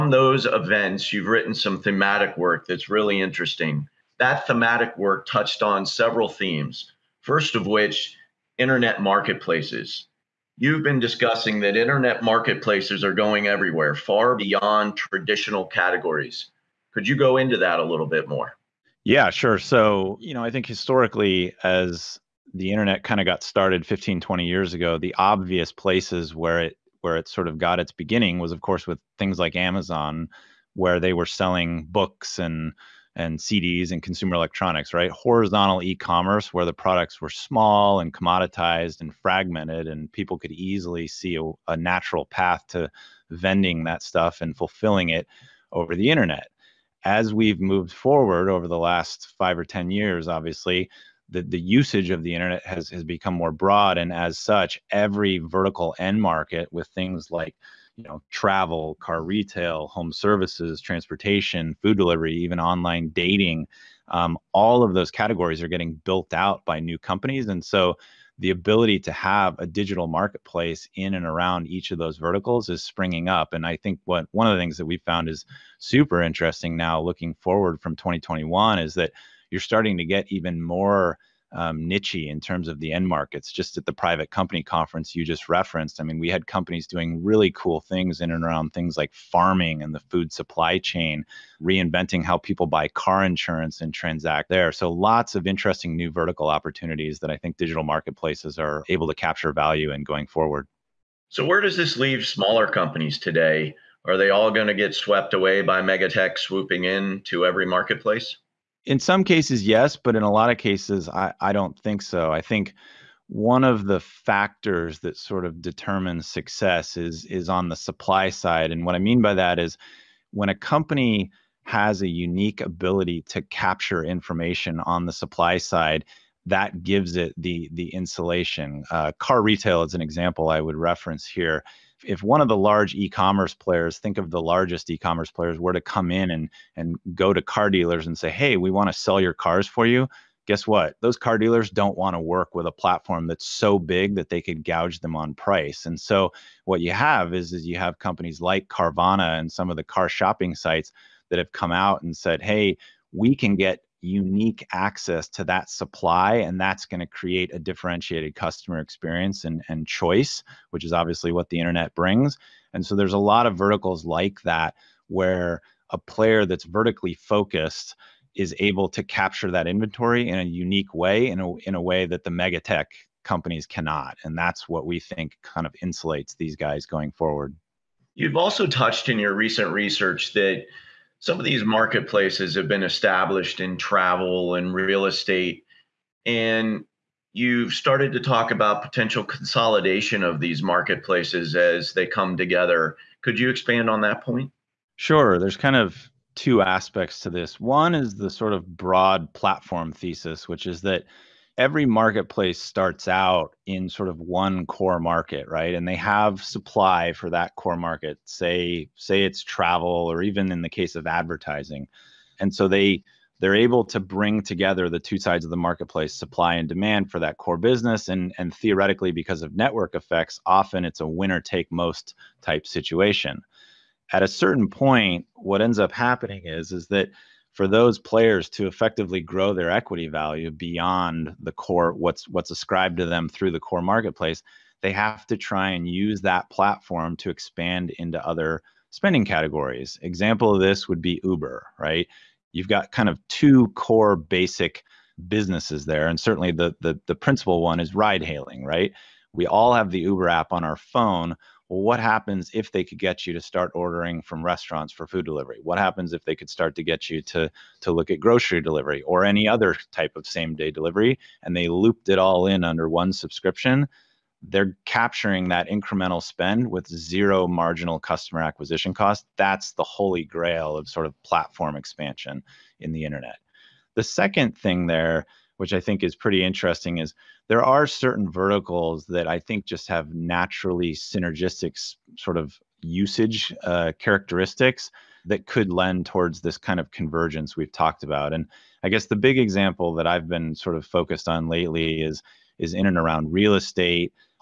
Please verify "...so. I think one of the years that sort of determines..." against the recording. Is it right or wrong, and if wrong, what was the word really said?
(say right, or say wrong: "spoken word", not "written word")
wrong: "factors", not "years".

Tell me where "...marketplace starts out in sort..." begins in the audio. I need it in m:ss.
3:21.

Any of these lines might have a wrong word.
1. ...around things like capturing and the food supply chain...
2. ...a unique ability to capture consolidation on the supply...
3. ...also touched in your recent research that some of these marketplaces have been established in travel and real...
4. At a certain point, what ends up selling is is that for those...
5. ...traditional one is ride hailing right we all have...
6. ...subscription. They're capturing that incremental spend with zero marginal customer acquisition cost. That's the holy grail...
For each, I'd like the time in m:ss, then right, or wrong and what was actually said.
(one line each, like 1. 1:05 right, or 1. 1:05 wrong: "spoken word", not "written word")
1. 1:28 wrong: "farming", not "capturing"
2. 2:02 wrong: "information", not "consolidation"
3. 2:58 right
4. 3:44 wrong: "happening", not "selling"
5. 4:07 wrong: "principal", not "traditional"
6. 4:23 right.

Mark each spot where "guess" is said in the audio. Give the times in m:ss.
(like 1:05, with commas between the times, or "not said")
2:20, 4:48.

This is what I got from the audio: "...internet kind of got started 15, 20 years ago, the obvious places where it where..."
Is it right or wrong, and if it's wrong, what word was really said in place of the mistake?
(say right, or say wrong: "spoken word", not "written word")
right.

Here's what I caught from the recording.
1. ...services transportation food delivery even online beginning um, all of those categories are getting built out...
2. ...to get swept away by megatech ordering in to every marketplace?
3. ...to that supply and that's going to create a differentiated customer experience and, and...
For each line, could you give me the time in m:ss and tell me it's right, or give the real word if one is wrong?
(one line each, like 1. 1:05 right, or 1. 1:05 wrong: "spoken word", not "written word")
1. 1:00 wrong: "dating", not "beginning"
2. 1:44 wrong: "swooping", not "ordering"
3. 2:35 right.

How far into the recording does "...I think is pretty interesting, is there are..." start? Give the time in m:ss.
4:35.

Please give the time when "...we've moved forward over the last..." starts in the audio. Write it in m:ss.
0:47.